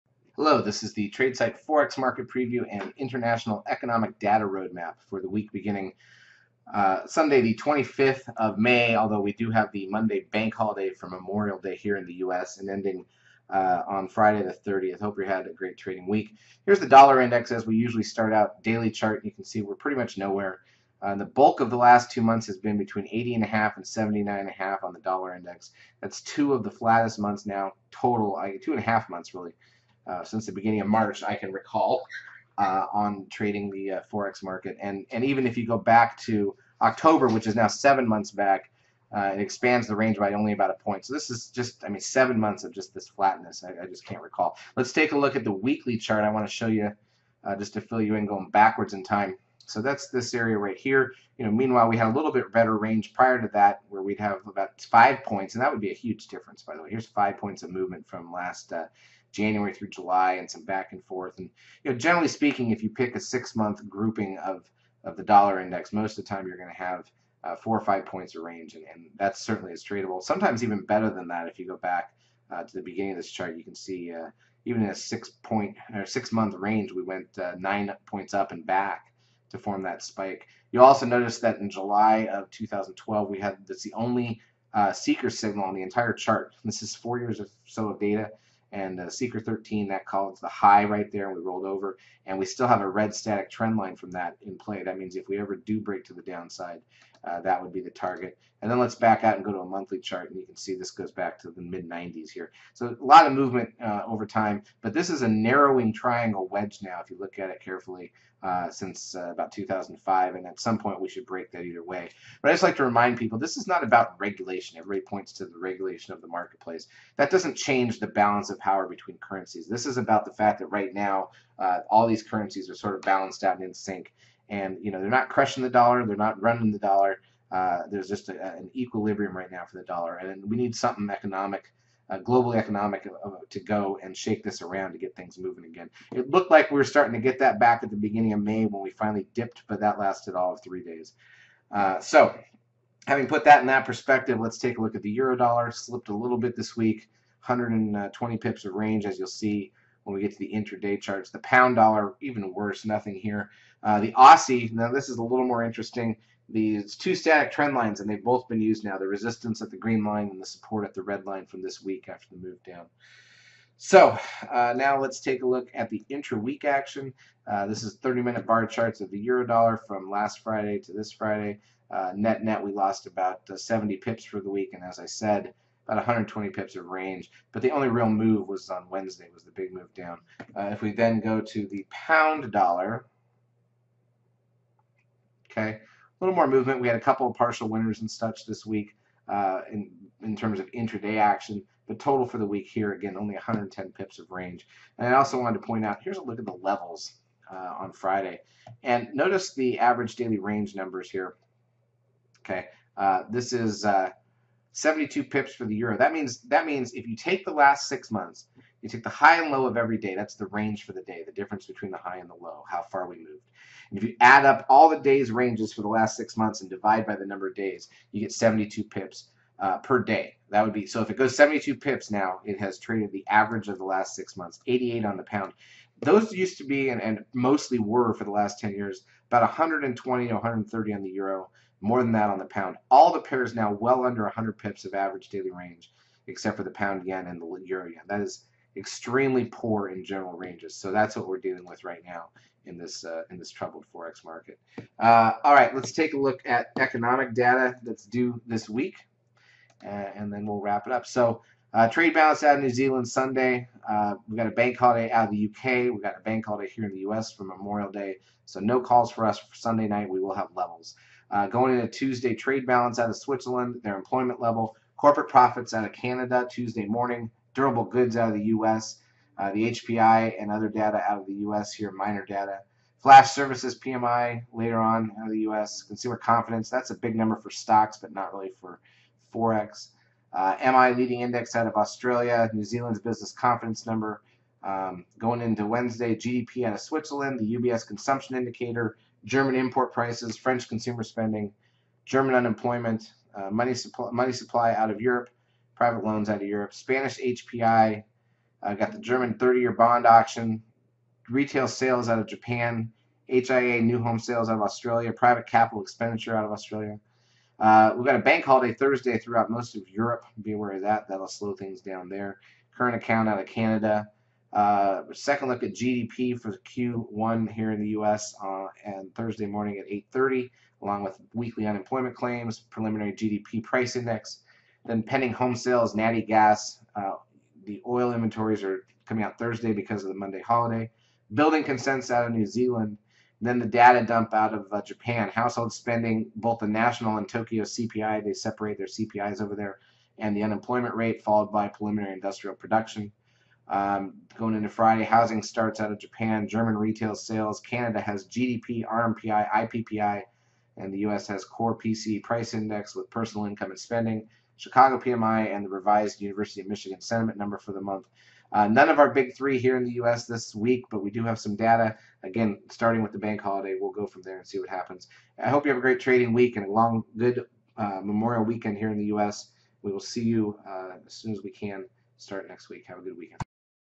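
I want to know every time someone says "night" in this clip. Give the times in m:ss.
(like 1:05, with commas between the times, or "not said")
4:19.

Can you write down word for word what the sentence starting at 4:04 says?
Uh, all right, let's take a look at economic data that's due this week, uh, and then we'll wrap it up.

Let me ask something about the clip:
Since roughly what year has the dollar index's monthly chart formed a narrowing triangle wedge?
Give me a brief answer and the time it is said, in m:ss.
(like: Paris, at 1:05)
2005, at 1:49.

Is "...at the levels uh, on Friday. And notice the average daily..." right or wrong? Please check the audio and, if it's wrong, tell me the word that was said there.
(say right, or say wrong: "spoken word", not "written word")
right.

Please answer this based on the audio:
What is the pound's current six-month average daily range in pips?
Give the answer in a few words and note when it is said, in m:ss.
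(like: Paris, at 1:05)
88, at 3:44.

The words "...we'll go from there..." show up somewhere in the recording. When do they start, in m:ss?
6:03.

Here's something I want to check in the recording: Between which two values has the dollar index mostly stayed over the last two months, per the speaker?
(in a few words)
80.5 and 79.5.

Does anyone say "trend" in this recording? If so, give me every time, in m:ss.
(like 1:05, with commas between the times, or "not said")
1:33, 2:37.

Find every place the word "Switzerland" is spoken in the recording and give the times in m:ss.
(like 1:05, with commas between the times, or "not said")
4:23, 4:46.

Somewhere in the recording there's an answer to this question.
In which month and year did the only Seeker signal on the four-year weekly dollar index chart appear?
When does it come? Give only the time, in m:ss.
1:21.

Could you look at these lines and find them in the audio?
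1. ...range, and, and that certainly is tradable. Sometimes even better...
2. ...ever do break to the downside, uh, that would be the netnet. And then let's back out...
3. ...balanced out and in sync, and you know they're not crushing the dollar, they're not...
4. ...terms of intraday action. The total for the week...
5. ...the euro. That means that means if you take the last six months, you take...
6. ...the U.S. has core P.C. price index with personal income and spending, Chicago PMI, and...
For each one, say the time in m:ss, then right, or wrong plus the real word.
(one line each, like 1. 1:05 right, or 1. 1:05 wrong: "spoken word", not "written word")
1. 1:08 right
2. 1:35 wrong: "target", not "netnet"
3. 2:03 right
4. 3:10 right
5. 3:25 right
6. 5:50 right.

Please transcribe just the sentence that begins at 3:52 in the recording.
All the pairs now well under 100 pips of average daily range, except for the pound yen and the euro yen.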